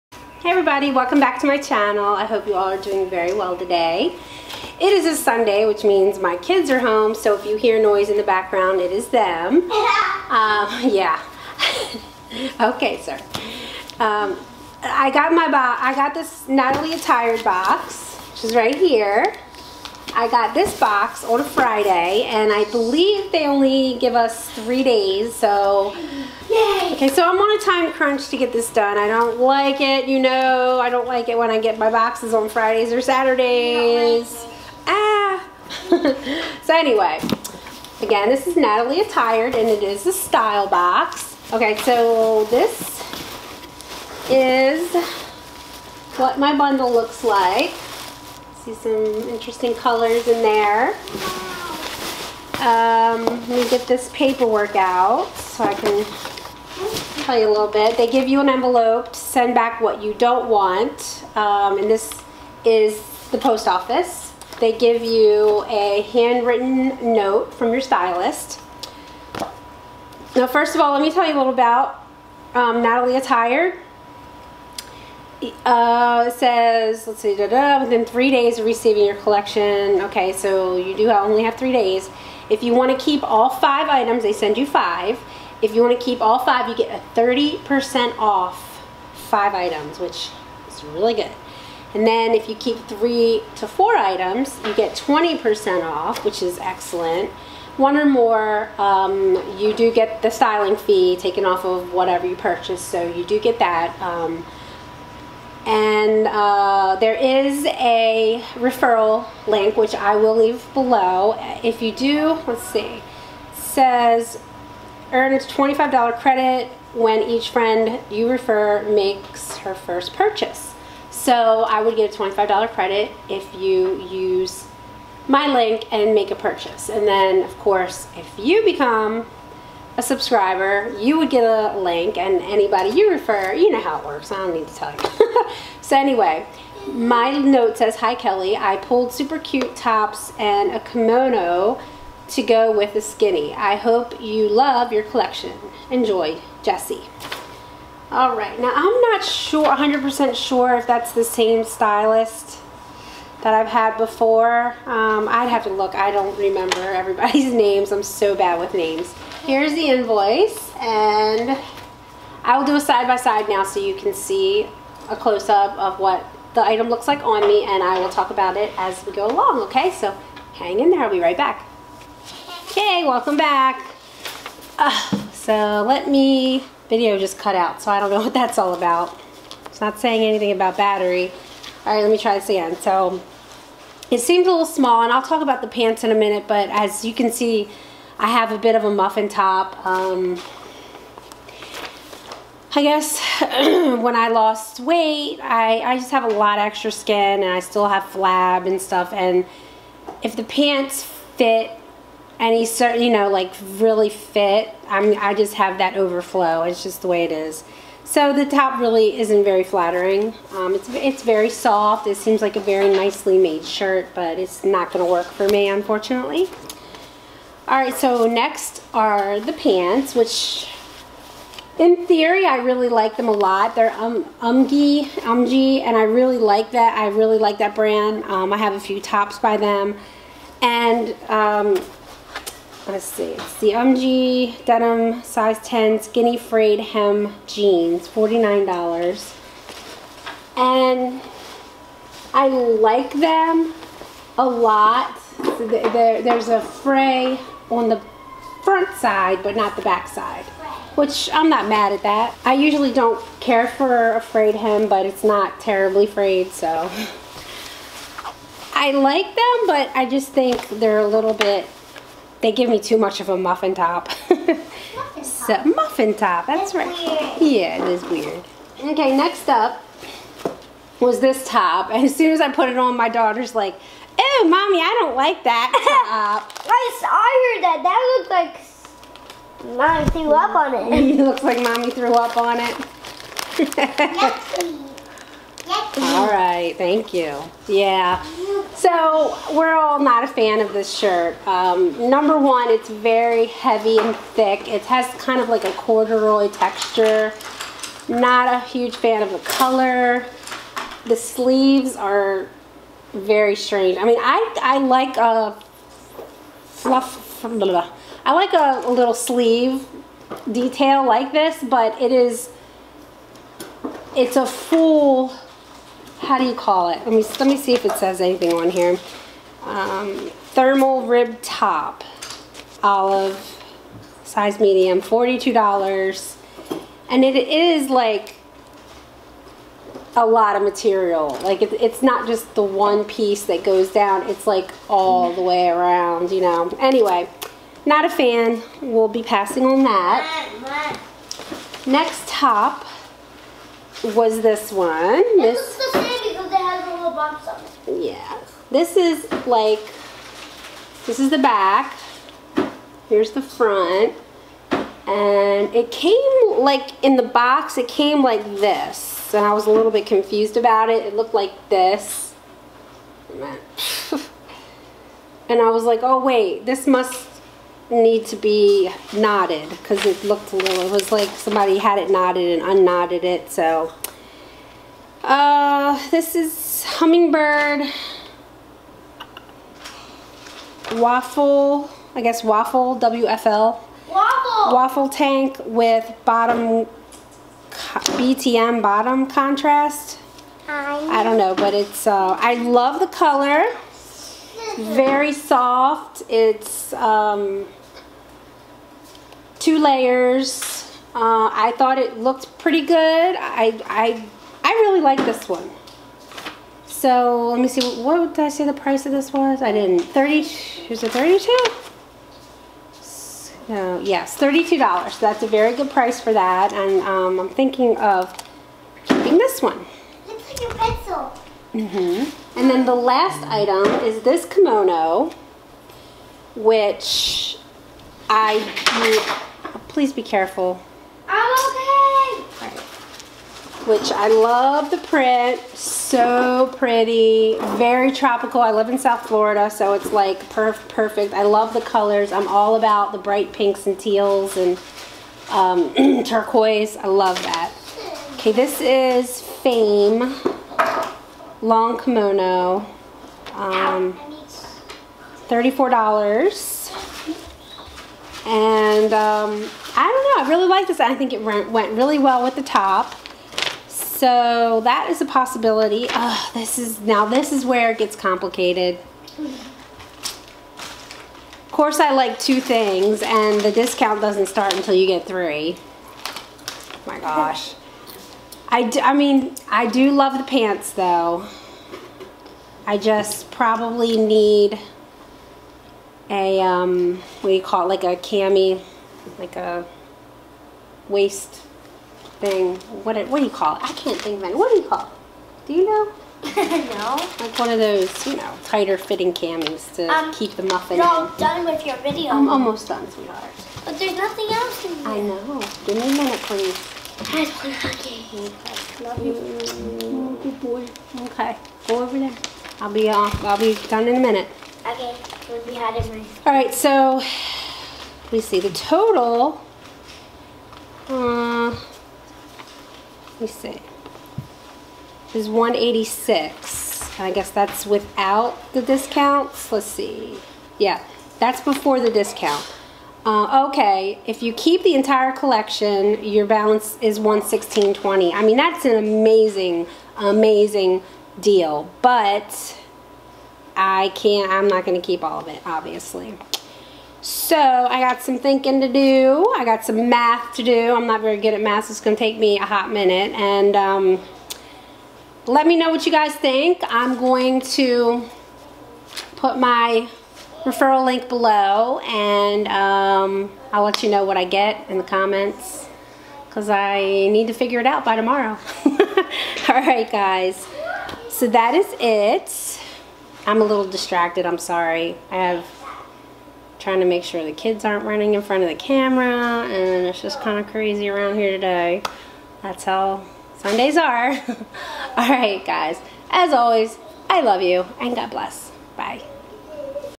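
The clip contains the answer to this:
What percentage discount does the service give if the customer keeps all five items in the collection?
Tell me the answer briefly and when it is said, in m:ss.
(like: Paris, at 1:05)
30%, at 1:27.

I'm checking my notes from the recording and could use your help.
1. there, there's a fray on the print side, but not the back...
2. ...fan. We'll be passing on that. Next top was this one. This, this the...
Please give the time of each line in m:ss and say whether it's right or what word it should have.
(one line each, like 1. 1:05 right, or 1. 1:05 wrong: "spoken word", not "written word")
1. 4:05 wrong: "front", not "print"
2. 5:38 right.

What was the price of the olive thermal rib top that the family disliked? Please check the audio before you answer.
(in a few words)
$42.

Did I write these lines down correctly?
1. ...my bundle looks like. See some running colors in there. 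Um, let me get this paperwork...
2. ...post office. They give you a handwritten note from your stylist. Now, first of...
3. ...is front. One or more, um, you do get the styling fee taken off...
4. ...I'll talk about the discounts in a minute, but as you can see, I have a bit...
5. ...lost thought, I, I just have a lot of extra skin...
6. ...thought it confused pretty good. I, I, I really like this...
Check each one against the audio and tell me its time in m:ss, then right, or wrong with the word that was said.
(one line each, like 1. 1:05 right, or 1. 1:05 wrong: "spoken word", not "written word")
1. 0:46 wrong: "interesting", not "running"
2. 1:03 right
3. 1:36 wrong: "excellent", not "front"
4. 3:05 wrong: "pants", not "discounts"
5. 3:14 wrong: "weight", not "thought"
6. 6:41 wrong: "looked", not "confused".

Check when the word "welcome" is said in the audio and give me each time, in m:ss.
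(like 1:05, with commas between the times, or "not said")
0:00, 2:53.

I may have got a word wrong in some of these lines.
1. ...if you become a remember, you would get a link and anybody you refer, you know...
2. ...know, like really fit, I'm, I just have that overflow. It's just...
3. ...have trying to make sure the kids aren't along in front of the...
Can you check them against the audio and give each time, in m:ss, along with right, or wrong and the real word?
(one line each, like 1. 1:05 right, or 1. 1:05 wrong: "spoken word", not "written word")
1. 2:08 wrong: "subscriber", not "remember"
2. 3:23 right
3. 9:35 wrong: "running", not "along".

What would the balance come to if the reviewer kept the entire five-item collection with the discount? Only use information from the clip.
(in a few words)
$116.20.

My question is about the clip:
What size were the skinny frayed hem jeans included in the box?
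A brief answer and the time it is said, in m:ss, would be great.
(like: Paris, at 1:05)
10, at 3:55.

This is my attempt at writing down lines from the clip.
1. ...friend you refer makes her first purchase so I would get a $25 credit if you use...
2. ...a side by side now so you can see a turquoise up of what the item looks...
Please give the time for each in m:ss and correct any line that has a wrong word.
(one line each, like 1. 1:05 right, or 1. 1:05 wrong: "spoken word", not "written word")
1. 1:57 right
2. 2:42 wrong: "close", not "turquoise".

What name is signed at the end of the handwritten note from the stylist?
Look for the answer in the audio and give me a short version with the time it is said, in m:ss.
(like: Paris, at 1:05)
Jesse, at 2:26.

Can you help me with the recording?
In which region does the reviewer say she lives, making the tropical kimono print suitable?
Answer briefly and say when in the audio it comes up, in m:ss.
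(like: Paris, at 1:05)
South Florida, at 7:18.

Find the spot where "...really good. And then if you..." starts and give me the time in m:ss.
1:30.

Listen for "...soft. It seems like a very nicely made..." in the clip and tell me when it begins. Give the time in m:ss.
3:31.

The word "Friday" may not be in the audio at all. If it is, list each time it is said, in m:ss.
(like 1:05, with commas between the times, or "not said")
0:21, 0:32.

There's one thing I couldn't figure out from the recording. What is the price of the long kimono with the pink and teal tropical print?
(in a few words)
$34.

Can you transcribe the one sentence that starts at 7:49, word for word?
Of course I like two things and the discount doesn't start until you get three.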